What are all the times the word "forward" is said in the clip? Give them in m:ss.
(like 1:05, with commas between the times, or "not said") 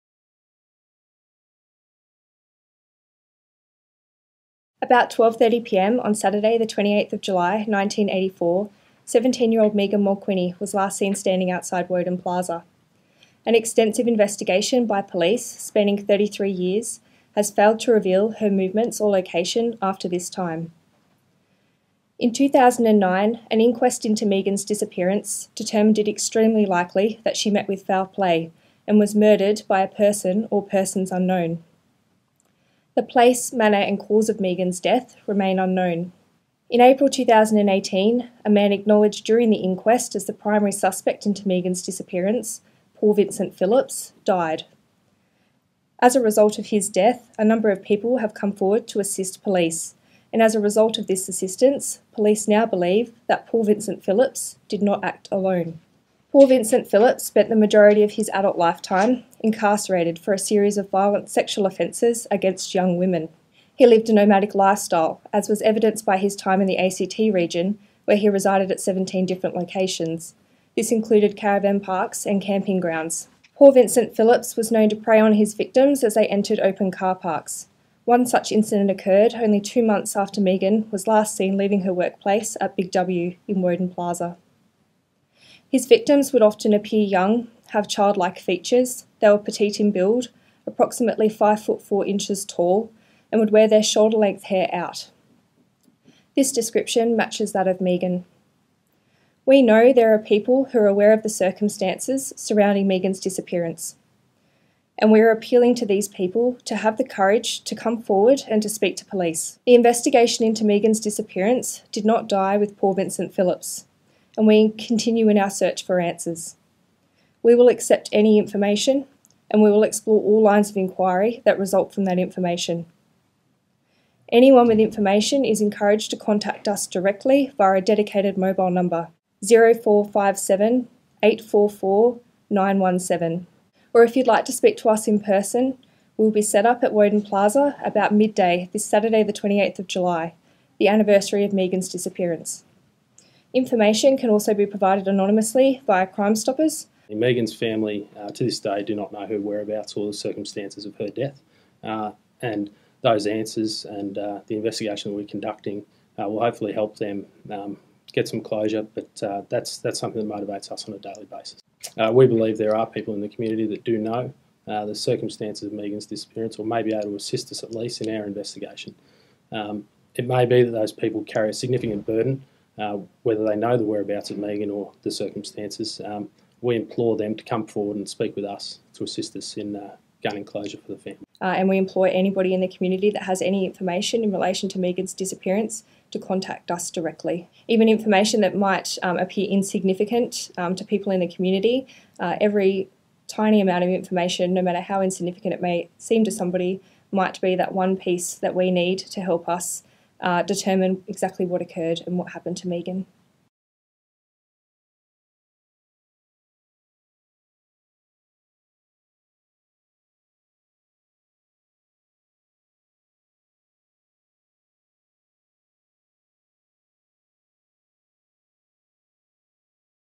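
0:48, 1:48, 2:57.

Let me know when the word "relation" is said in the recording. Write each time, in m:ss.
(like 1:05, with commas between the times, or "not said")
3:04.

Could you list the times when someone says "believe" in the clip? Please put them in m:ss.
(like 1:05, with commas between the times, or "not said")
0:52, 2:42.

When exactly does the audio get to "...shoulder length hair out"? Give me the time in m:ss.
1:33.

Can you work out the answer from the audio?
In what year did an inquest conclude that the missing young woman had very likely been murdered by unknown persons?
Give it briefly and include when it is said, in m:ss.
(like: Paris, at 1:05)
2009, at 0:22.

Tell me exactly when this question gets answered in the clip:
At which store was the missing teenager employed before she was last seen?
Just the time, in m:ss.
1:22.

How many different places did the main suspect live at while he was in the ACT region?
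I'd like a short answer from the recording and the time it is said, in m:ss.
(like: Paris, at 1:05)
17, at 1:08.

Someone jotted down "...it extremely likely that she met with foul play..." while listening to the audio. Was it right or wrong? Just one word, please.
right.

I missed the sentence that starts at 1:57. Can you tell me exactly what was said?
We will accept any information and we will explore all lines of inquiry that result from that information.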